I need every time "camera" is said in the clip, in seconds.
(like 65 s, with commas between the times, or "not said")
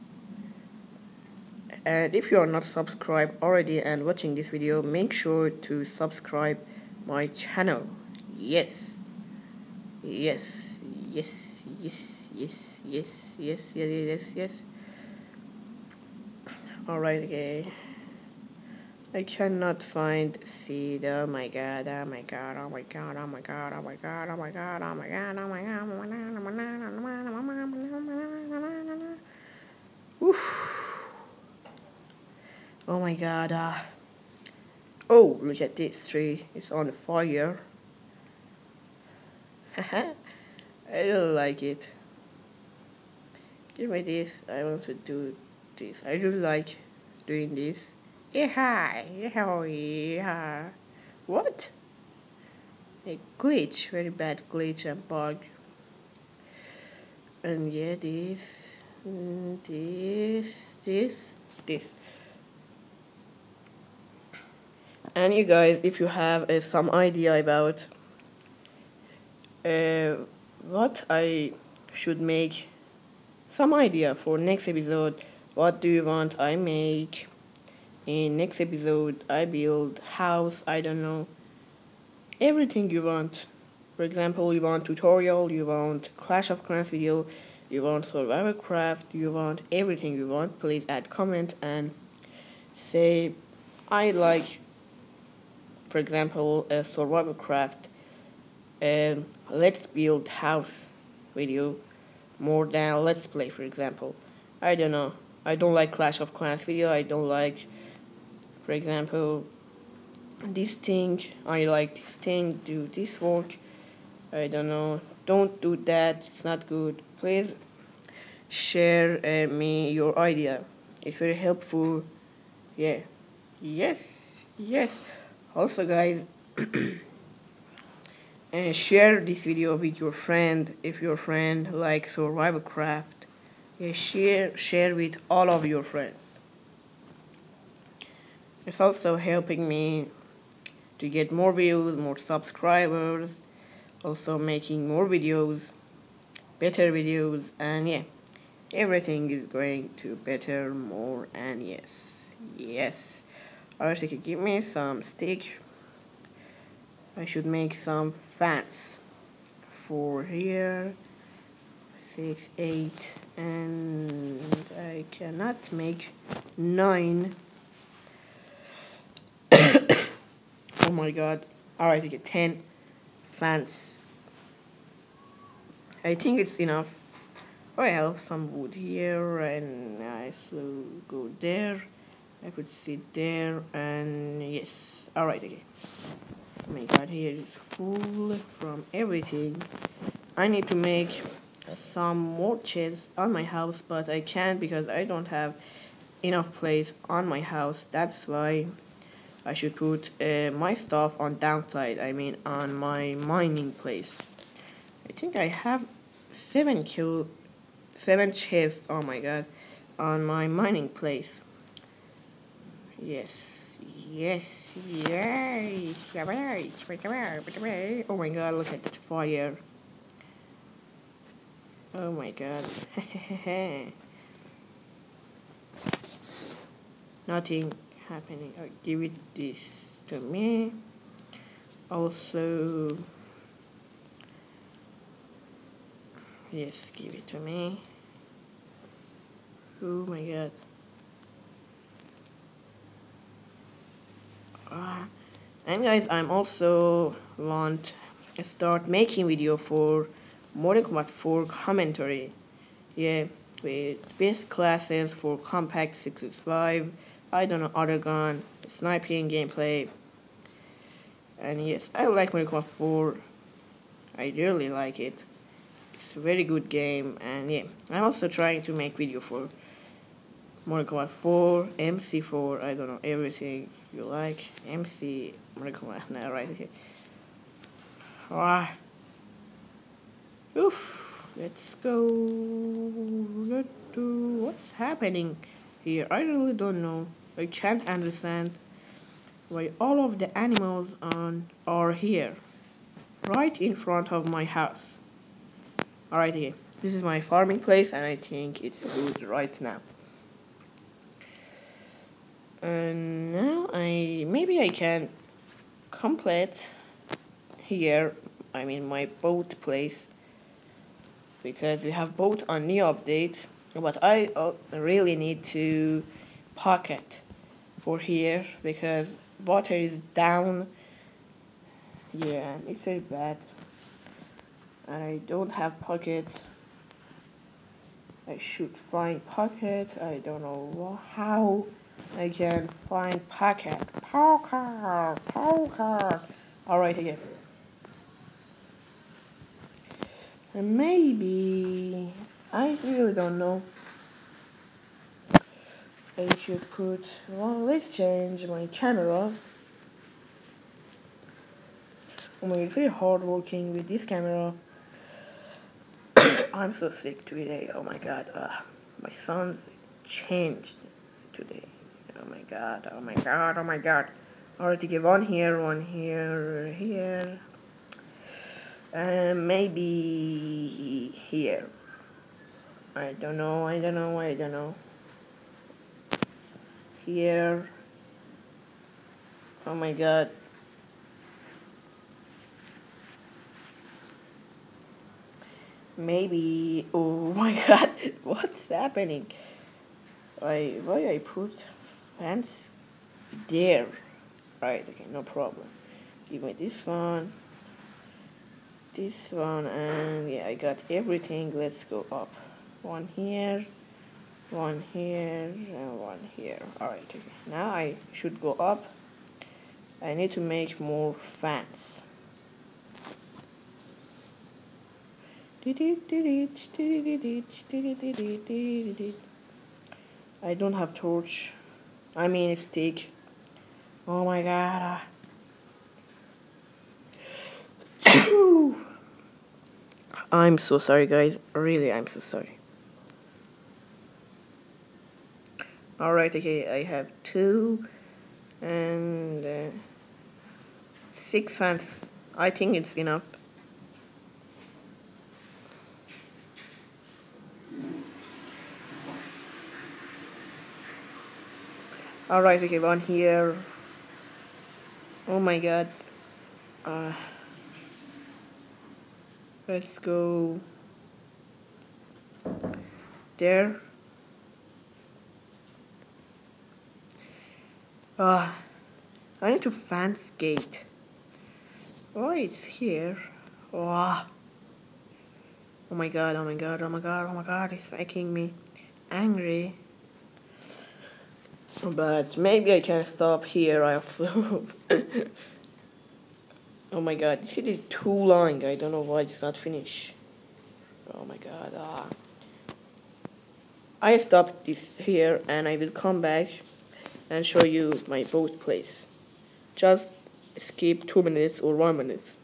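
348 s, 354 s.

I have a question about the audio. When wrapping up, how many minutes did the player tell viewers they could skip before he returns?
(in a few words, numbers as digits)
2.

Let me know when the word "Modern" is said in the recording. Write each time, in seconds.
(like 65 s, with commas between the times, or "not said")
250 s, 262 s, 270 s.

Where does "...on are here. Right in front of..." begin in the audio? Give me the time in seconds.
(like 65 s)
291 s.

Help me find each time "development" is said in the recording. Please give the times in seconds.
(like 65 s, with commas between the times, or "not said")
not said.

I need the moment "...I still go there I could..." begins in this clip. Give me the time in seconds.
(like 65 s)
180 s.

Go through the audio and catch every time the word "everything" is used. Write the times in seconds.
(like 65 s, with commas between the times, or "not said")
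82 s, 89 s, 148 s, 188 s, 273 s, 400 s.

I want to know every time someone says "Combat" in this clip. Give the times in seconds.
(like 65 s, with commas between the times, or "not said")
250 s, 262 s, 270 s.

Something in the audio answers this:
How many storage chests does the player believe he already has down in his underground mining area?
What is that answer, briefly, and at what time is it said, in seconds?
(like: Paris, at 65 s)
7, at 207 s.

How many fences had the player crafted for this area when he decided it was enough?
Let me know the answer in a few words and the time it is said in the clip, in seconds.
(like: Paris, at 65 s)
10, at 172 s.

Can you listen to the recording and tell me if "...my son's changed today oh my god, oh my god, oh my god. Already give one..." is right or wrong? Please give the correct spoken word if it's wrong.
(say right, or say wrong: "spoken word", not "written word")
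right.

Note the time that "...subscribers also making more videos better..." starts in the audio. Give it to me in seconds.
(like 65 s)
142 s.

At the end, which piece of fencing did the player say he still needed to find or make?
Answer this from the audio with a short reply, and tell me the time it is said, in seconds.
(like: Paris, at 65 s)
fence gate, at 469 s.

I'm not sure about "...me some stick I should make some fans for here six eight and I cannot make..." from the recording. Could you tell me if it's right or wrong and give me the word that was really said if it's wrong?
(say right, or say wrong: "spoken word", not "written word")
right.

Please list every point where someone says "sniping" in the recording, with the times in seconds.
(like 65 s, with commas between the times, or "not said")
258 s.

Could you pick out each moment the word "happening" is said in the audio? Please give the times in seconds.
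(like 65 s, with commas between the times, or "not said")
228 s, 284 s, 388 s.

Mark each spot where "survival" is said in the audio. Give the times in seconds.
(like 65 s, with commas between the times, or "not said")
88 s, 96 s, 132 s.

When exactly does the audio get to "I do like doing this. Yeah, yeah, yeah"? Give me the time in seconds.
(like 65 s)
46 s.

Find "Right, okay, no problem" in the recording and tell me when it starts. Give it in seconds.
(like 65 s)
394 s.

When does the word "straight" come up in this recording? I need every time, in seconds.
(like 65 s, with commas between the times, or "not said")
not said.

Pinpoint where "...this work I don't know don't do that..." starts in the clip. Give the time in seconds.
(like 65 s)
112 s.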